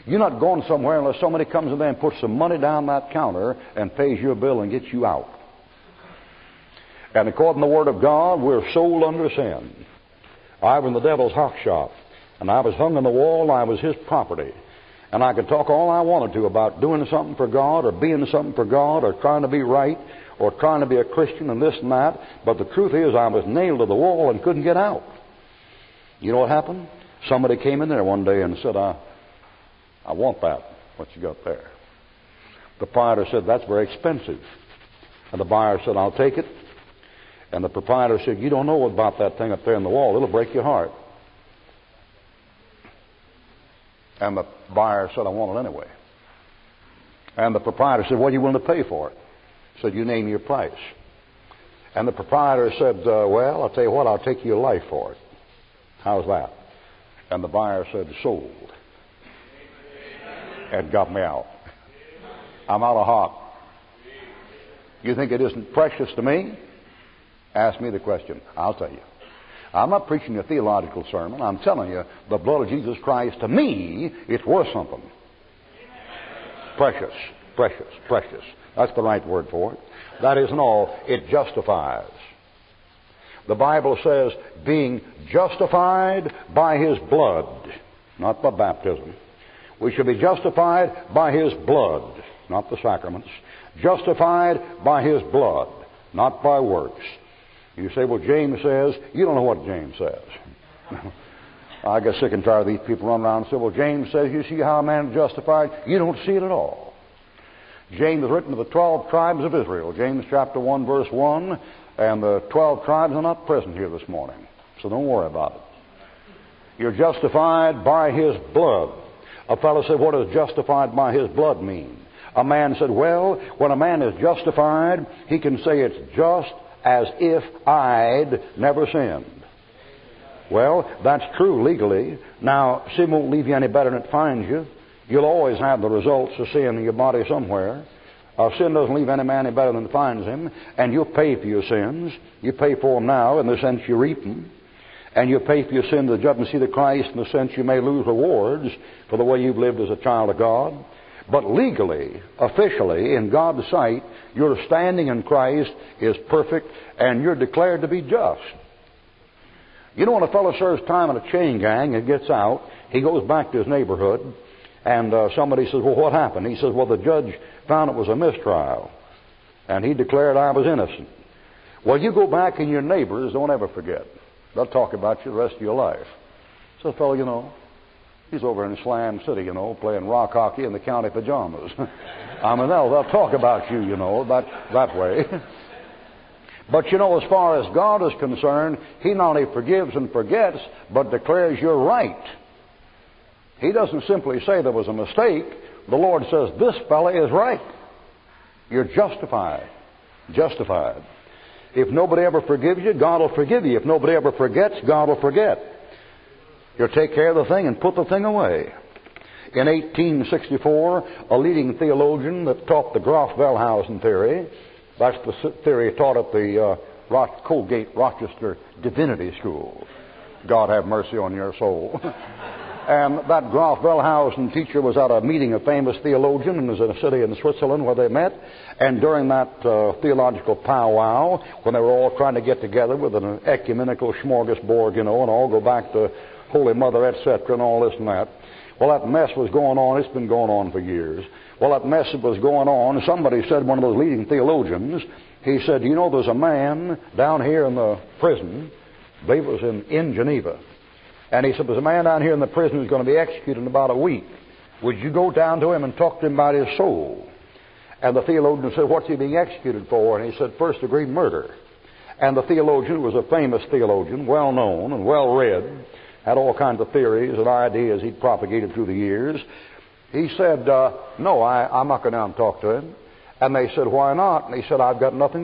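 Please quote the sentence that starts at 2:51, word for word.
Well, you go back and your neighbors don't ever forget.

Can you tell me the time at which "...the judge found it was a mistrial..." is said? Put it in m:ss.
2:46.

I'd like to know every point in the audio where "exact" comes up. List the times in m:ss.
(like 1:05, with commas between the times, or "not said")
not said.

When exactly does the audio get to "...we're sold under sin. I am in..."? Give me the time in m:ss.
0:08.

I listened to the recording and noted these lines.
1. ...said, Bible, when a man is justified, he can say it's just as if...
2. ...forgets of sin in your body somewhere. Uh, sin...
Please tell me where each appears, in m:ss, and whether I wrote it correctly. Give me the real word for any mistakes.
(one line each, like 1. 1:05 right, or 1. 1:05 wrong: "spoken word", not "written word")
1. 2:02 wrong: "Well", not "Bible"
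2. 2:15 wrong: "results", not "forgets".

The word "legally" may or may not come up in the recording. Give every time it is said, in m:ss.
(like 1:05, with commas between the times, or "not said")
2:11, 2:31.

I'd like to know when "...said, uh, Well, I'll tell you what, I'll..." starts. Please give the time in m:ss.
0:52.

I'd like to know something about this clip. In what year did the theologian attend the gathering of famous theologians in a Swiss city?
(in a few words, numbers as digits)
1864.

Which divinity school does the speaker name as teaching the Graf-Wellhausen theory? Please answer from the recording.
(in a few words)
Colgate Rochester Divinity School.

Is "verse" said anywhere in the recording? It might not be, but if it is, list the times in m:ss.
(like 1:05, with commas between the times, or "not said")
1:50.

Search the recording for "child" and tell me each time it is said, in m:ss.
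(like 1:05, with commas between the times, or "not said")
2:29.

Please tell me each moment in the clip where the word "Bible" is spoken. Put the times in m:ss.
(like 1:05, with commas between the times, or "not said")
1:23.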